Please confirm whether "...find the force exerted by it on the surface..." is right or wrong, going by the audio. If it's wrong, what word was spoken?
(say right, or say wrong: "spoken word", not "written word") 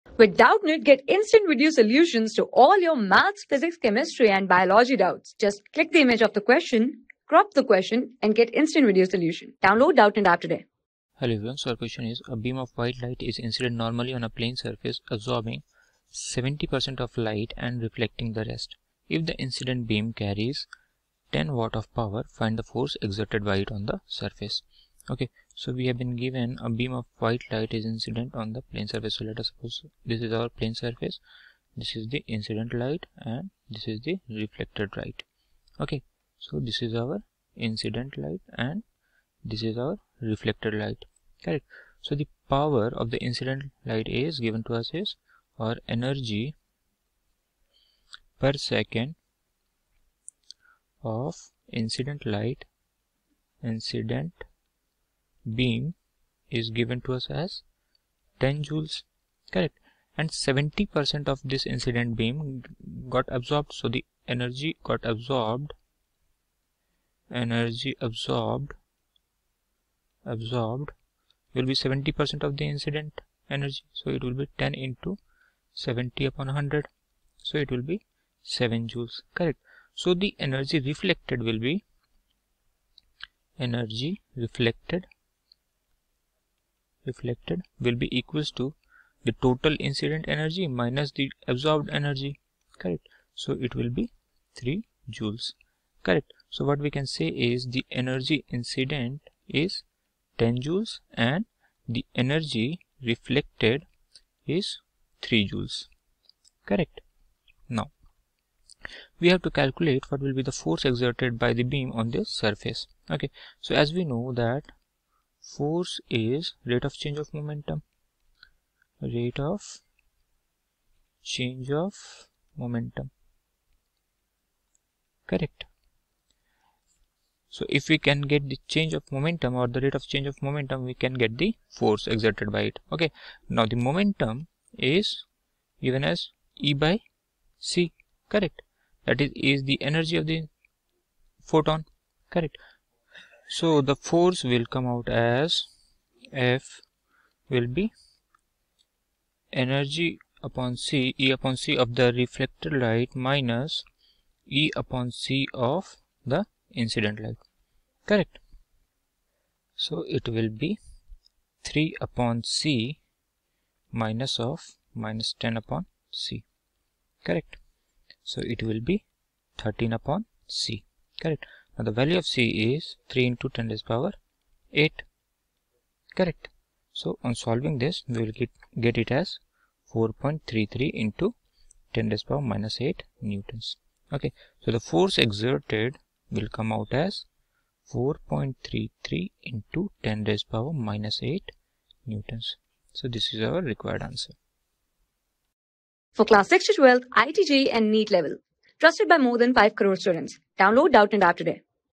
right.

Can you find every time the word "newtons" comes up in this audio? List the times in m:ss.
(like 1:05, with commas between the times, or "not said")
3:03, 3:12.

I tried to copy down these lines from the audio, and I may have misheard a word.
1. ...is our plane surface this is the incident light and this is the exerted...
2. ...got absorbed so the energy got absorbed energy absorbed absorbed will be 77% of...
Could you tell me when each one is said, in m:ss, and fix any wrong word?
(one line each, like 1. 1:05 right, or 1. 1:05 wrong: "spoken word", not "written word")
1. 0:30 wrong: "reflected", not "exerted"
2. 1:03 wrong: "70", not "77".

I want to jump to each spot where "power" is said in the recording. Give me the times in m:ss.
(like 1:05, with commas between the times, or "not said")
0:21, 0:42, 2:53, 3:02, 3:10.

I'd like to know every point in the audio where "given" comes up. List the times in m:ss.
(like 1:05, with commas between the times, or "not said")
0:26, 0:44, 0:56, 2:15.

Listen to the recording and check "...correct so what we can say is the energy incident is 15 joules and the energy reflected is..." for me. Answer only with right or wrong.
wrong.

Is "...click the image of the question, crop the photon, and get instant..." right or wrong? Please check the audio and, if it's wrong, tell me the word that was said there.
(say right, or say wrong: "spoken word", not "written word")
wrong: "question", not "photon".